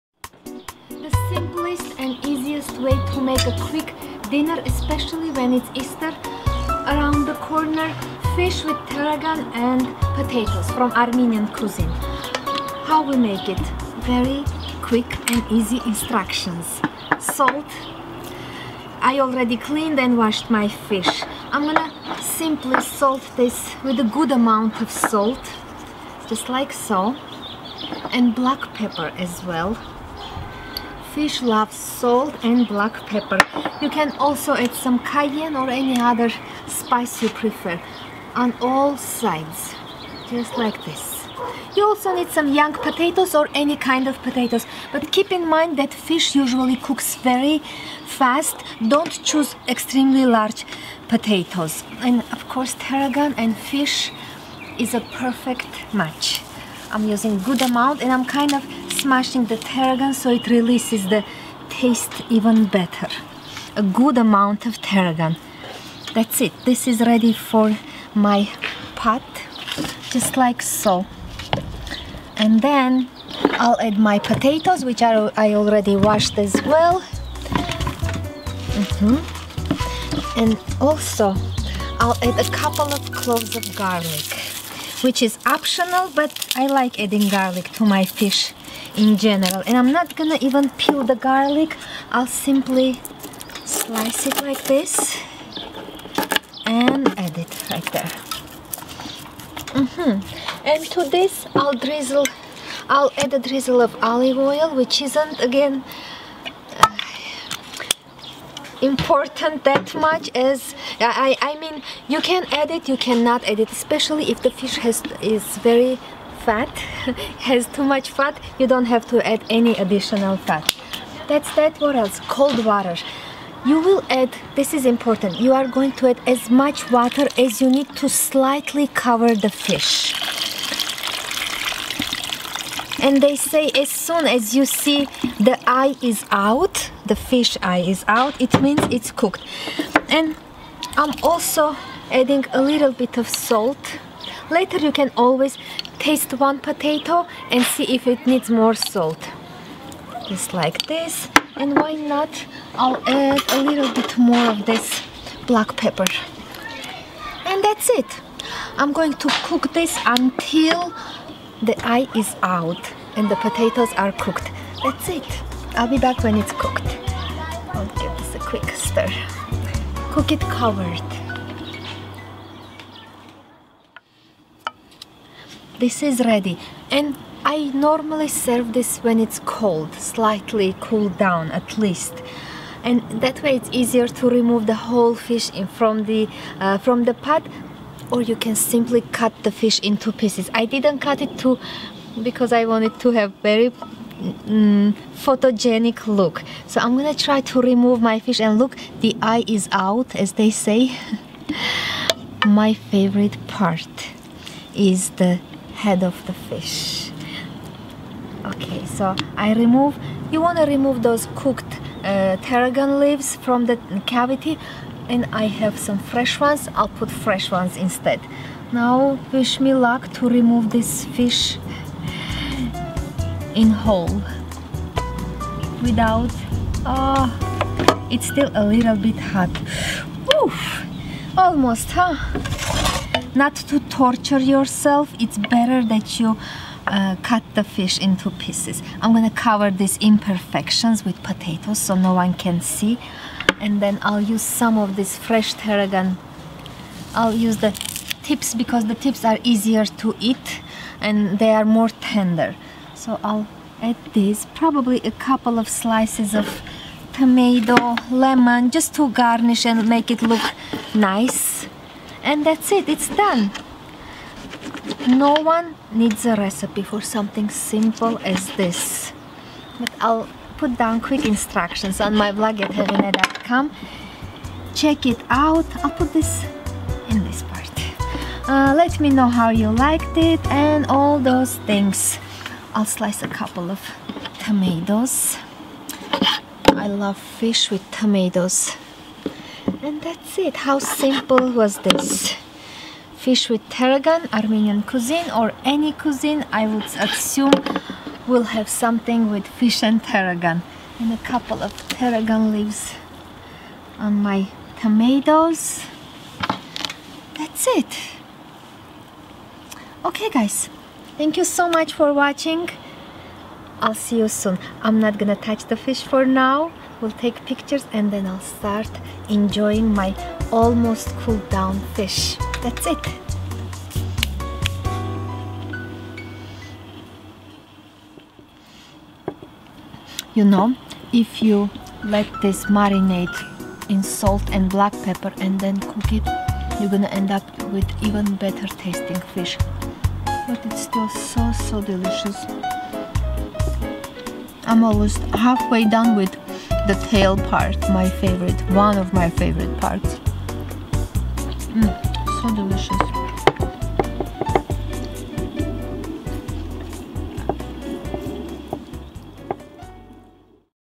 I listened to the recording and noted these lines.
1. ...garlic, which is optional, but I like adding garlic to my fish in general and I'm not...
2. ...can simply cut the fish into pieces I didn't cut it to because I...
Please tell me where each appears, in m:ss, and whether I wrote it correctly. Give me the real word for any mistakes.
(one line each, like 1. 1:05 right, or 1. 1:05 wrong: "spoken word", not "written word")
1. 1:23 right
2. 3:08 right.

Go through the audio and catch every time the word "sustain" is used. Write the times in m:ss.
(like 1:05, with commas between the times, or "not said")
not said.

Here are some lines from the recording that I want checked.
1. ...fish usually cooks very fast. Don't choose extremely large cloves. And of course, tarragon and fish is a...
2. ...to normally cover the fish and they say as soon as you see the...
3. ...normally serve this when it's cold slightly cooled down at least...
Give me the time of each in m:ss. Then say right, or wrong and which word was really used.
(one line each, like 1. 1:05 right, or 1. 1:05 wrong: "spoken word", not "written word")
1. 0:45 wrong: "potatoes", not "cloves"
2. 2:08 wrong: "slightly", not "normally"
3. 2:57 right.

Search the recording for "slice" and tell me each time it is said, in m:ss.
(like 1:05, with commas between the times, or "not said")
1:33, 4:15, 4:42.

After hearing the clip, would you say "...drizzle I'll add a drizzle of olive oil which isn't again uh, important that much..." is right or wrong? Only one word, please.
right.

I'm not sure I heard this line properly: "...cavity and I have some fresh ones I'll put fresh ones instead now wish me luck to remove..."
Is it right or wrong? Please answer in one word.
right.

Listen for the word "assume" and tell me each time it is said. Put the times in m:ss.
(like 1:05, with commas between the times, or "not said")
4:56.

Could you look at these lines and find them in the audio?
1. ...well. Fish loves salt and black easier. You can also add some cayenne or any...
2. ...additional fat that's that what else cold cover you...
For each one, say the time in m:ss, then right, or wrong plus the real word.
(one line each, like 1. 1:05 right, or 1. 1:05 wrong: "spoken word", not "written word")
1. 0:29 wrong: "pepper", not "easier"
2. 1:59 wrong: "water", not "cover".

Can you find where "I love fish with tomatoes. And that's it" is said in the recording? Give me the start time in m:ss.
4:46.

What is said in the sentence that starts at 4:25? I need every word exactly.
No one needs a recipe for something simple as this.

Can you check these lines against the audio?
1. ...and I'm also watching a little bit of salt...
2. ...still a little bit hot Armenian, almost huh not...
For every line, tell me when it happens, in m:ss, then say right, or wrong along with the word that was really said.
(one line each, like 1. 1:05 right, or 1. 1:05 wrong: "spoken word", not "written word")
1. 2:20 wrong: "adding", not "watching"
2. 3:48 wrong: "Oof", not "Armenian".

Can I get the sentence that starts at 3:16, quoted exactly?
So I'm gonna try to remove my fish and look, the eye is out as they say.